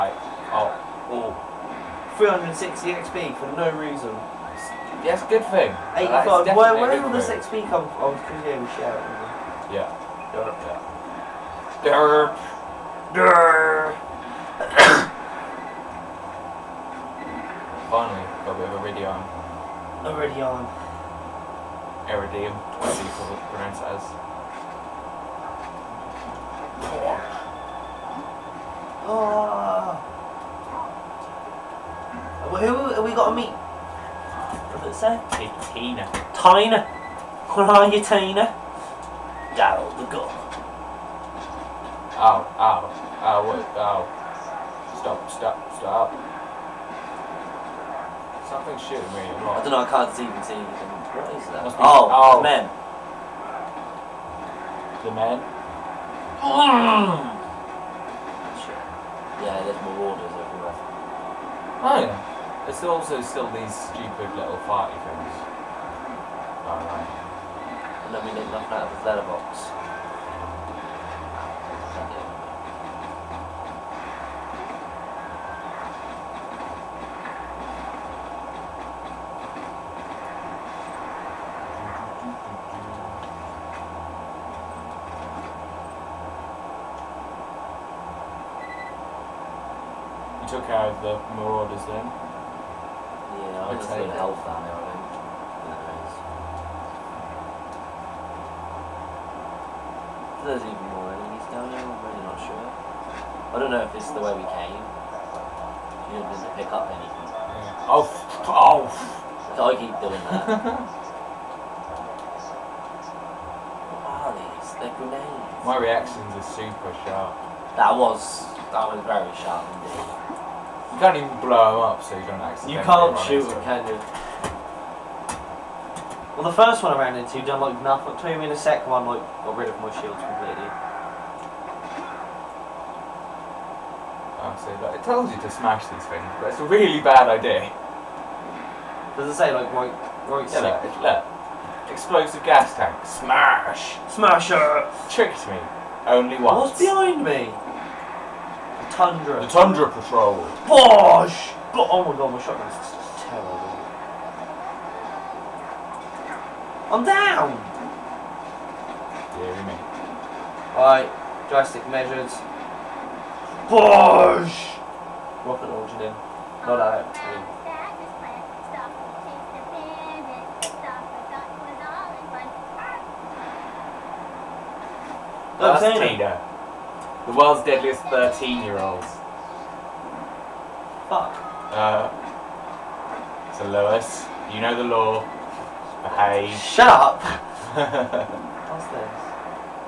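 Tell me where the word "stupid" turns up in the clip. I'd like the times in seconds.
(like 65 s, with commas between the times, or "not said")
63 s.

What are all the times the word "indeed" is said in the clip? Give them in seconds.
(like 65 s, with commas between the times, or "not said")
119 s.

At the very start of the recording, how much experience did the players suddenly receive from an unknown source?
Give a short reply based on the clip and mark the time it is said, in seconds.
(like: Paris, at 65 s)
360 XP, at 2 s.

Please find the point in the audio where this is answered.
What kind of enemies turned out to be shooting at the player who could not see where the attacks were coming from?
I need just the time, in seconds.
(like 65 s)
59 s.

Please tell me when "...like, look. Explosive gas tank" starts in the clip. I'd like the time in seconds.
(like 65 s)
140 s.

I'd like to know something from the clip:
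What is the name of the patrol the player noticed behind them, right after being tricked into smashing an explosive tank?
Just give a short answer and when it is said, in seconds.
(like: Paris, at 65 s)
The Tundra Patrol, at 149 s.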